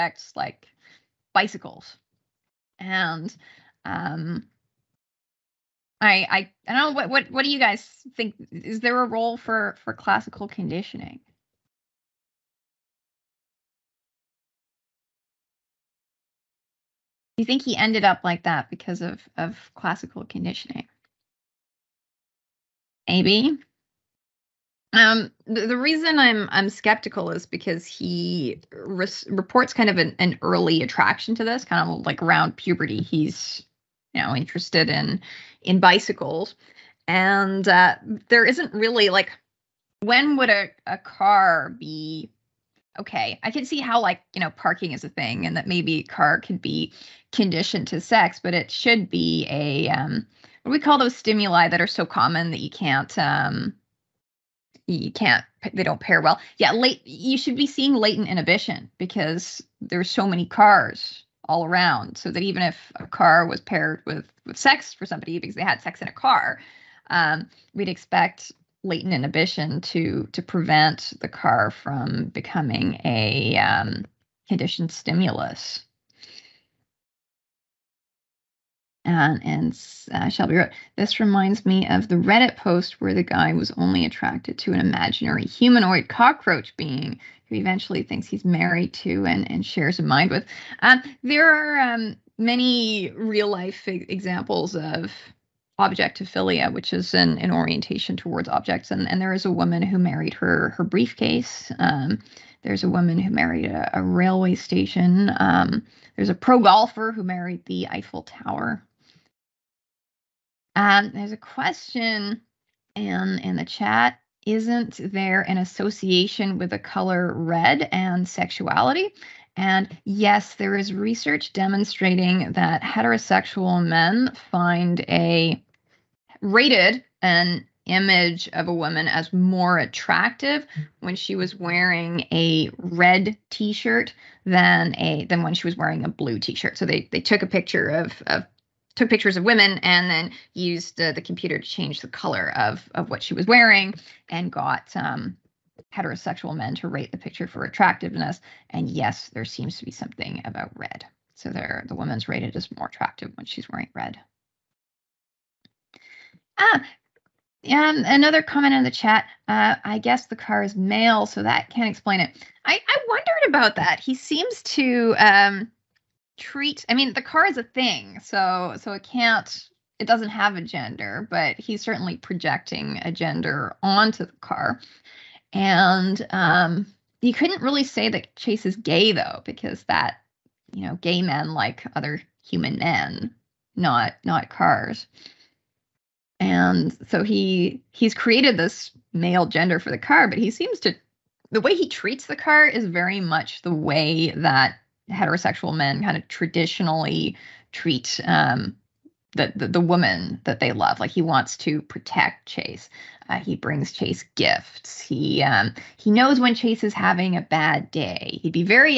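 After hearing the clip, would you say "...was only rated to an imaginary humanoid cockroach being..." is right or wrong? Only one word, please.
wrong.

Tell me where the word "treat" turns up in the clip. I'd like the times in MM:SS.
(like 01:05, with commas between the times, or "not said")
02:46, 03:11, 03:17.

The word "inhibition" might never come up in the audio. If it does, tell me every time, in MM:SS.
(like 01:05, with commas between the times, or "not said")
00:58, 01:09.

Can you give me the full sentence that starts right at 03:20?
Like he wants to protect Chase.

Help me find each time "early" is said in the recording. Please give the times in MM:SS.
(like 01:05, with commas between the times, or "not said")
00:30.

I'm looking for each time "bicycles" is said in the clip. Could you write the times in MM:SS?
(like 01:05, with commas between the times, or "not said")
00:01, 00:35.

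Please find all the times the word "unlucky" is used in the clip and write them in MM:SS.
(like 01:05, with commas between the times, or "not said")
not said.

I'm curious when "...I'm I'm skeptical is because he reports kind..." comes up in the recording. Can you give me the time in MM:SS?
00:26.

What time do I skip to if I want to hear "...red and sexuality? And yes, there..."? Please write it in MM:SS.
01:57.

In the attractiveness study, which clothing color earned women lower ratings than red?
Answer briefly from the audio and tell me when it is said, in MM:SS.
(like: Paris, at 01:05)
Blue, at 02:16.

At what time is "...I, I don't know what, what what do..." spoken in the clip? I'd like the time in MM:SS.
00:06.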